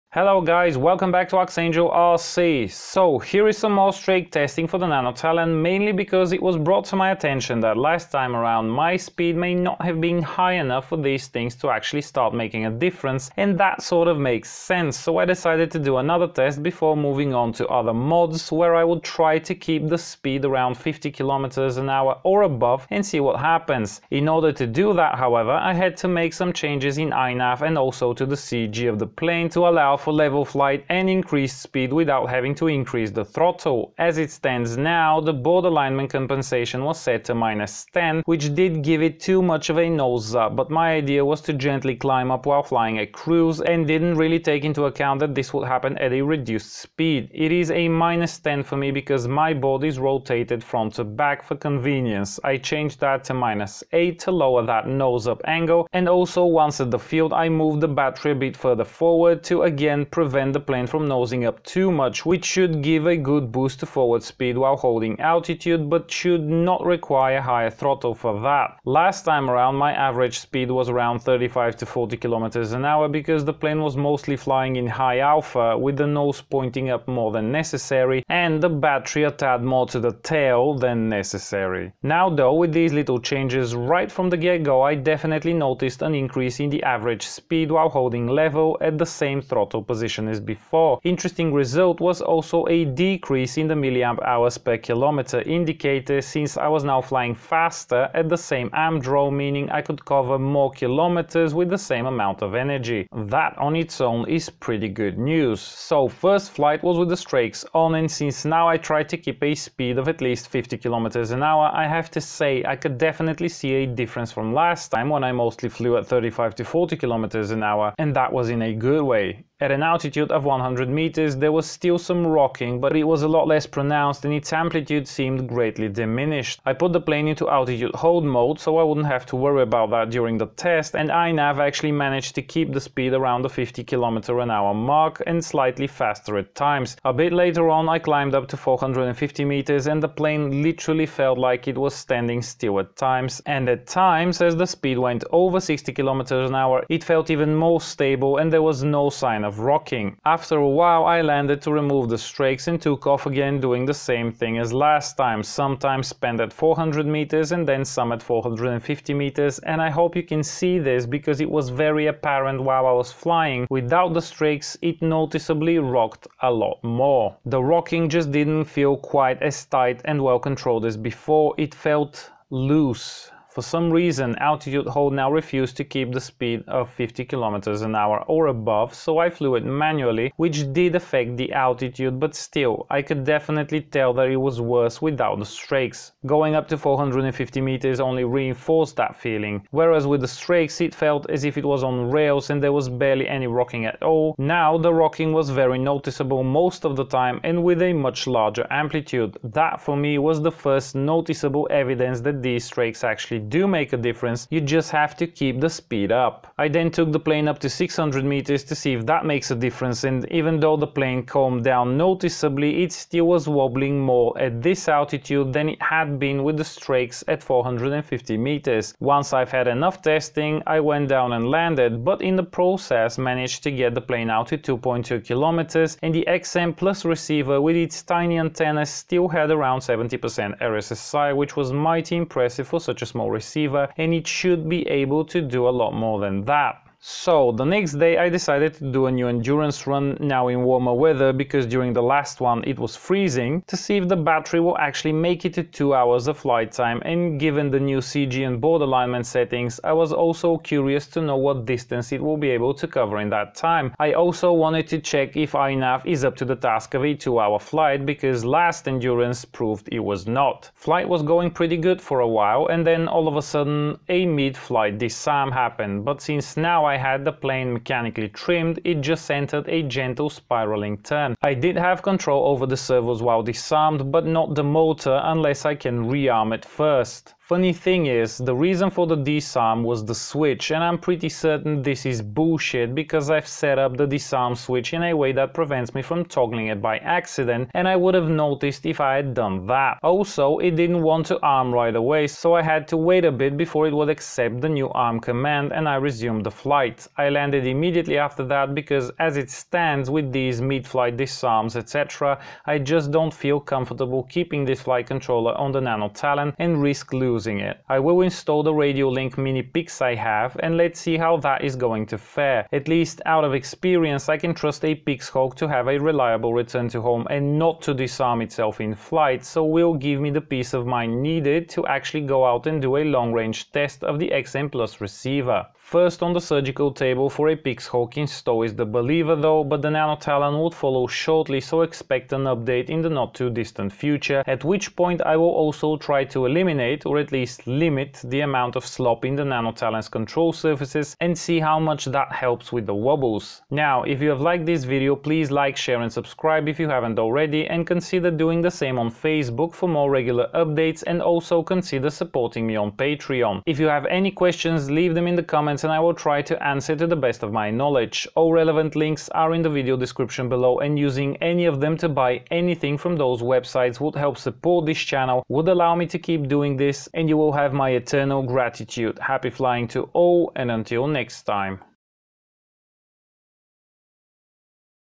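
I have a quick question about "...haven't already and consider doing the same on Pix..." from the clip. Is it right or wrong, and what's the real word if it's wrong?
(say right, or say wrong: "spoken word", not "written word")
wrong: "Facebook", not "Pix".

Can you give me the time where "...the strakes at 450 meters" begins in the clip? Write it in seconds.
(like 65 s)
216 s.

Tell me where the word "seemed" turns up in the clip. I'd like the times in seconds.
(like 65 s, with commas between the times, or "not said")
125 s.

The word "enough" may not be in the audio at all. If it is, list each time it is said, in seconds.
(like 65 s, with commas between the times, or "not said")
10 s, 219 s.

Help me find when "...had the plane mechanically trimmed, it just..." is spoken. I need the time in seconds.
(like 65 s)
266 s.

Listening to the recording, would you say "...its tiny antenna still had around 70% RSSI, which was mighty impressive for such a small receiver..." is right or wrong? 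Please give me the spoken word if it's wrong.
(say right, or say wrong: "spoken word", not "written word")
right.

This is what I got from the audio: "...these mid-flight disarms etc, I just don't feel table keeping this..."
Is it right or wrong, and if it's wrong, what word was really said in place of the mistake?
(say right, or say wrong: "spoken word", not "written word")
wrong: "comfortable", not "table".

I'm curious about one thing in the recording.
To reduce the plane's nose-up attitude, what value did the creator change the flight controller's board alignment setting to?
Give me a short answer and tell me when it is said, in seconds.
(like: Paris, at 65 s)
-8, at 53 s.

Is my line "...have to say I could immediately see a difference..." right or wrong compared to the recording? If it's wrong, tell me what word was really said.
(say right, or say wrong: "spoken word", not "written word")
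wrong: "definitely", not "immediately".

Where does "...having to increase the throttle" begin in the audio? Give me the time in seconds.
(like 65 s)
32 s.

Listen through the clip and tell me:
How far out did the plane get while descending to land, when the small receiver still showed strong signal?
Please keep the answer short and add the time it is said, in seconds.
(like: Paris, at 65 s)
2.2 kilometers, at 224 s.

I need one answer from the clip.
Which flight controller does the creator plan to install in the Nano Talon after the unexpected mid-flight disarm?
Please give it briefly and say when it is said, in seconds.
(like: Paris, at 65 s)
Radiolink Mini Pix, at 308 s.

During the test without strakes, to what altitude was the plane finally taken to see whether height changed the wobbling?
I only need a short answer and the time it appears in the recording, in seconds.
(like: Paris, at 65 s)
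600 meters, at 207 s.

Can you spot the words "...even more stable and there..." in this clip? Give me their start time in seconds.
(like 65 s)
147 s.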